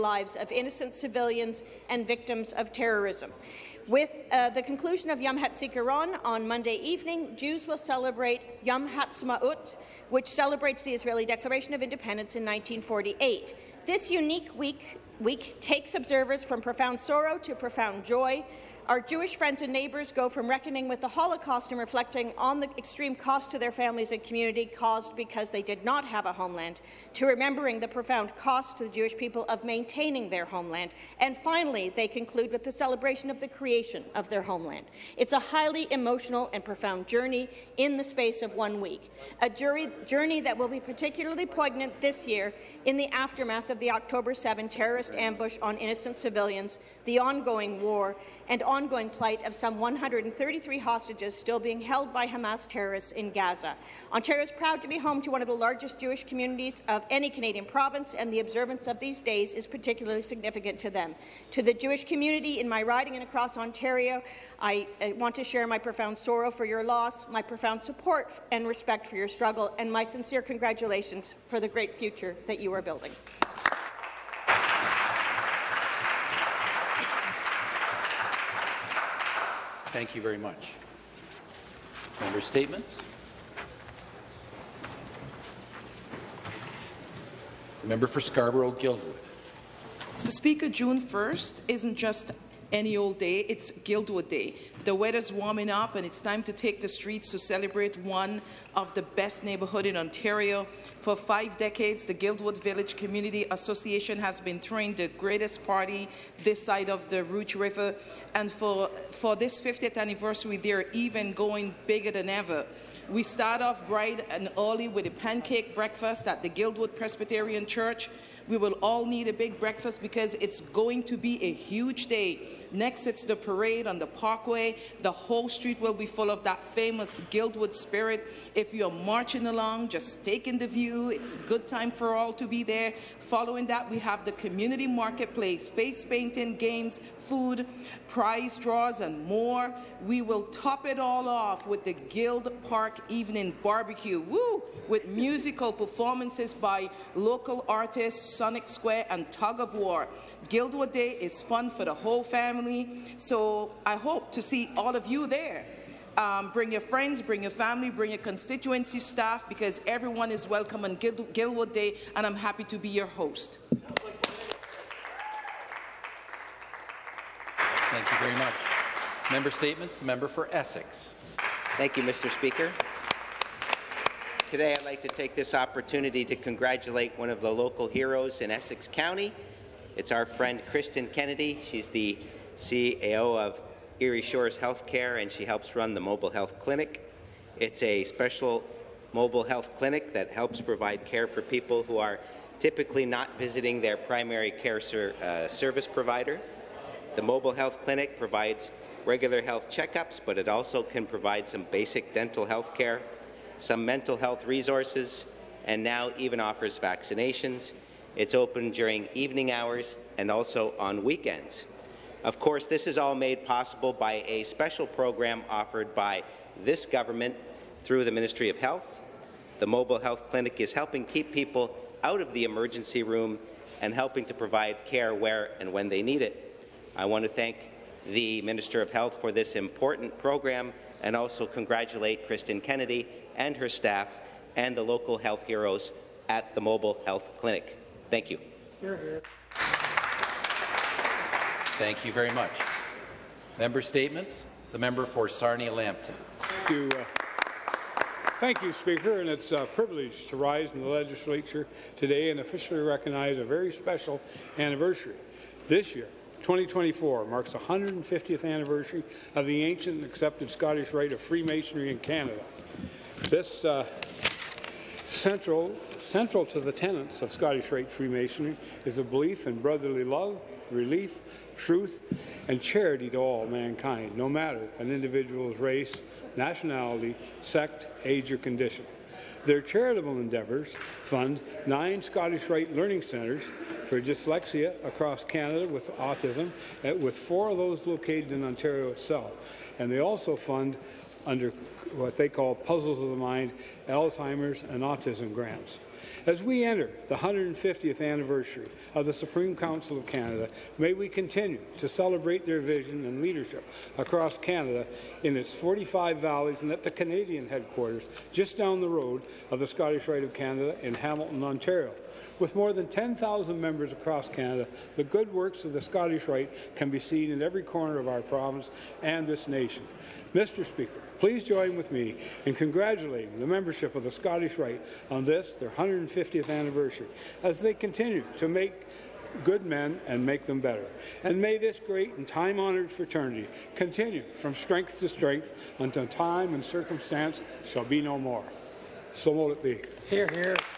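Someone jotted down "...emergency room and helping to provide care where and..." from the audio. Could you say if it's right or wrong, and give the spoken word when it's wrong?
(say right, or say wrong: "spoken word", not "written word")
right.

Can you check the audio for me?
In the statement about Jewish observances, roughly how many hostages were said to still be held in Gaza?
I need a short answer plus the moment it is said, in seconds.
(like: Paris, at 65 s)
133, at 49 s.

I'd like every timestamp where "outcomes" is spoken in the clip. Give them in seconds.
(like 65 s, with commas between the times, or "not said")
not said.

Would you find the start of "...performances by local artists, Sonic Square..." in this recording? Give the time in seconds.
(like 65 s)
145 s.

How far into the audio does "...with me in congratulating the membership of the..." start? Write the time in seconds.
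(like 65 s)
321 s.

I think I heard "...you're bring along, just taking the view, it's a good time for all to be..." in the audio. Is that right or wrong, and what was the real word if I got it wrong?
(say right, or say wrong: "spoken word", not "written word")
wrong: "marching", not "bring".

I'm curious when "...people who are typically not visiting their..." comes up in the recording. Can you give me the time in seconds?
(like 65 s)
191 s.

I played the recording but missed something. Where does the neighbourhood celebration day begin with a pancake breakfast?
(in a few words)
Guildwood Presbyterian Church.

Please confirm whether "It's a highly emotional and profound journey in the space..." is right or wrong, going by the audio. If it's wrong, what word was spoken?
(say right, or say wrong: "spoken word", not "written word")
right.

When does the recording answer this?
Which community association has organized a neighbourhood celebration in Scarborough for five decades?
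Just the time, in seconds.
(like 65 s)
102 s.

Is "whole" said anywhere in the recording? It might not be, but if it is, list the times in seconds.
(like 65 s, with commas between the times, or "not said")
125 s, 151 s.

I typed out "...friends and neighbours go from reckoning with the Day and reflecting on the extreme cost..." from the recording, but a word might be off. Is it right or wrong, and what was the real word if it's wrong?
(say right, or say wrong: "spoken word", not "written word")
wrong: "Holocaust", not "Day".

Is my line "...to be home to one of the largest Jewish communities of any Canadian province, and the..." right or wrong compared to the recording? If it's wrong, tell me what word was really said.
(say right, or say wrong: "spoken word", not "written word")
right.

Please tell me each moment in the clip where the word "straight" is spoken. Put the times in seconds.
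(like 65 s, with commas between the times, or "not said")
not said.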